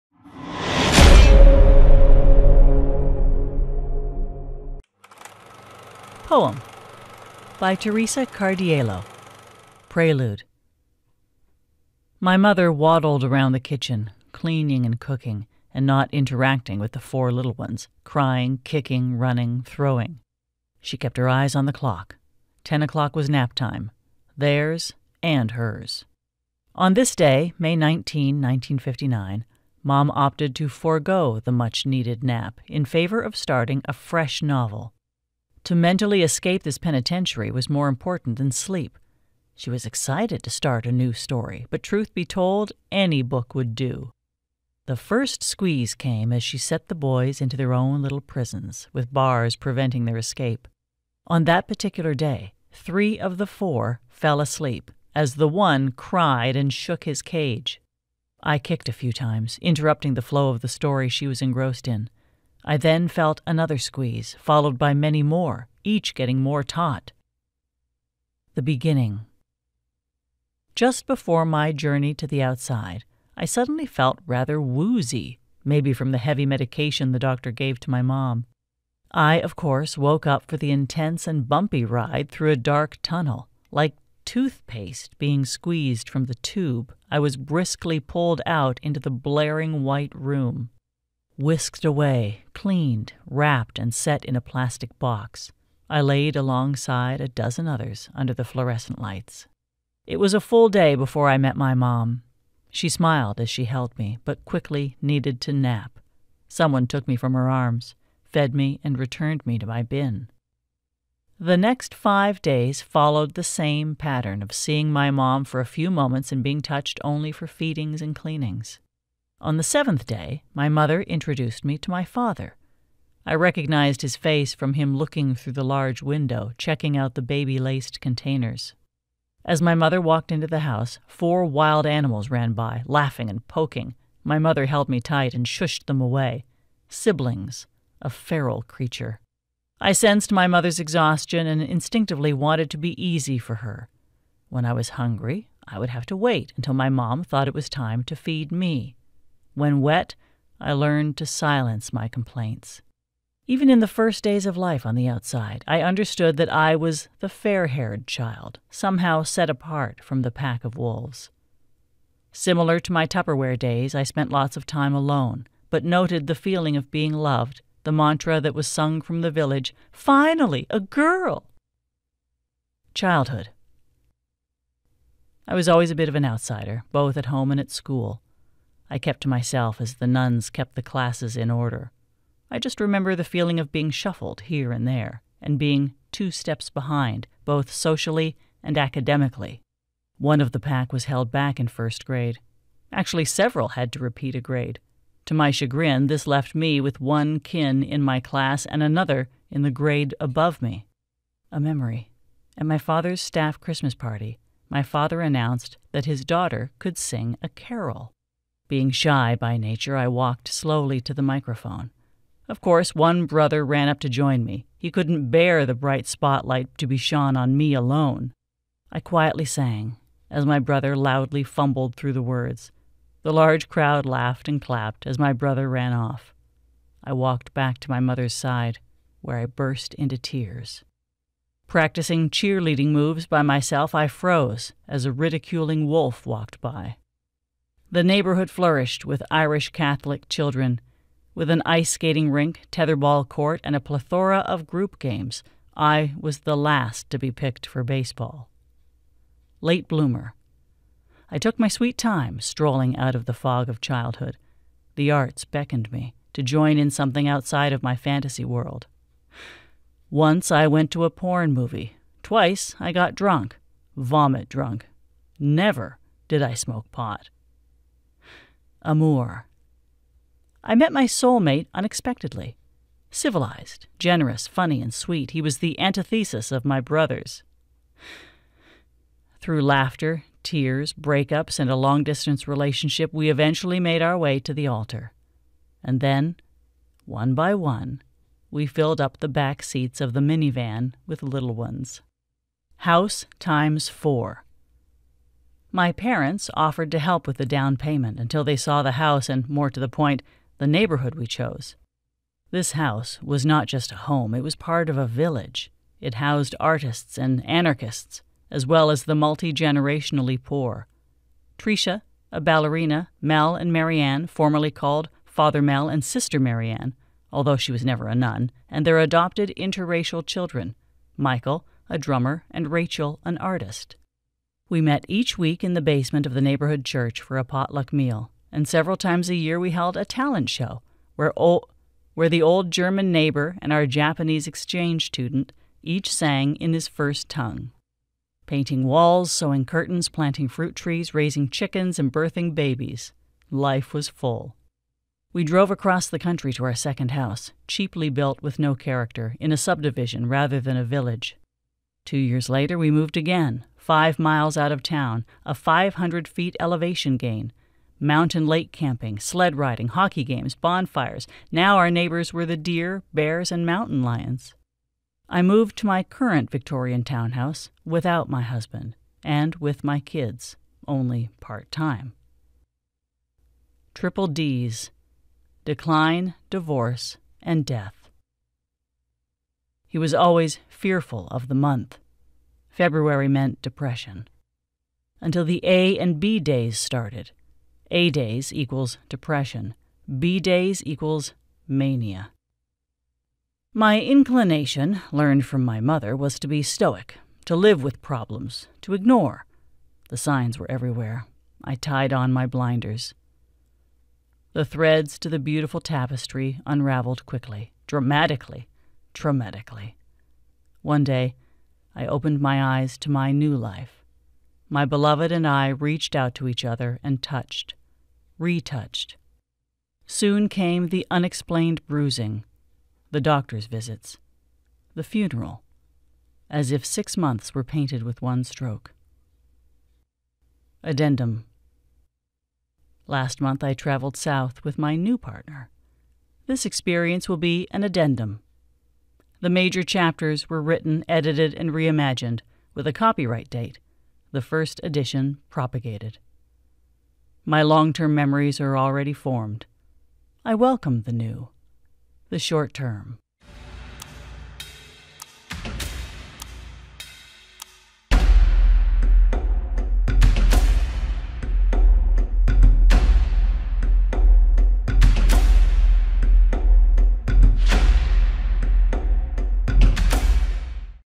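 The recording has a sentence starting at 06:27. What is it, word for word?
A days equals depression, B days equals mania.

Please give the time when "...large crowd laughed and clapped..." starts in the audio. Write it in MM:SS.
03:43.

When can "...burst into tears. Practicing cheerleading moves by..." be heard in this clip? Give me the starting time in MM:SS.
03:49.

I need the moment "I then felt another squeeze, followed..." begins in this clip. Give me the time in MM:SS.
01:02.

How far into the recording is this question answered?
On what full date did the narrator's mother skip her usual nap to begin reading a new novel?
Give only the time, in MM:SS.
00:27.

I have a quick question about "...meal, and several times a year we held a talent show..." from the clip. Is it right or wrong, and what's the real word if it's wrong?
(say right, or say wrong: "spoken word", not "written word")
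right.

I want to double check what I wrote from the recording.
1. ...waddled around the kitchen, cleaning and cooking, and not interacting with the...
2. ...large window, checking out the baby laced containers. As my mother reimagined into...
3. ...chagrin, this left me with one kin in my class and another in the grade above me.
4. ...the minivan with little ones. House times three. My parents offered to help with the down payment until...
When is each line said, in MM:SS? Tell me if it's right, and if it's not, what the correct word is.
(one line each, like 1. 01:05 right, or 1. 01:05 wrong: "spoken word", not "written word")
1. 00:12 right
2. 02:05 wrong: "walked", not "reimagined"
3. 03:15 right
4. 04:50 wrong: "four", not "three".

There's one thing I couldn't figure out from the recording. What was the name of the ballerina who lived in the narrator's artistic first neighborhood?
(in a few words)
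Tricia.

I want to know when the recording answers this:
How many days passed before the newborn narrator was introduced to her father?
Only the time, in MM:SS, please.
01:59.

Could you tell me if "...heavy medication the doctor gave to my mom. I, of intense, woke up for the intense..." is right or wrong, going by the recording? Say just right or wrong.
wrong.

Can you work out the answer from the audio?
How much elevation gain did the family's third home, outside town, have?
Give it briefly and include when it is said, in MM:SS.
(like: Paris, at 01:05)
500 feet, at 05:55.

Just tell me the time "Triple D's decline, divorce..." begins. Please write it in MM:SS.
06:13.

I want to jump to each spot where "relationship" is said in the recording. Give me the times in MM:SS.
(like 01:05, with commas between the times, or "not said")
04:42.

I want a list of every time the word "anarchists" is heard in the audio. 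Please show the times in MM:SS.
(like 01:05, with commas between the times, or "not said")
05:07.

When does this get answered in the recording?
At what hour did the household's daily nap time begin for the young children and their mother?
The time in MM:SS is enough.
00:22.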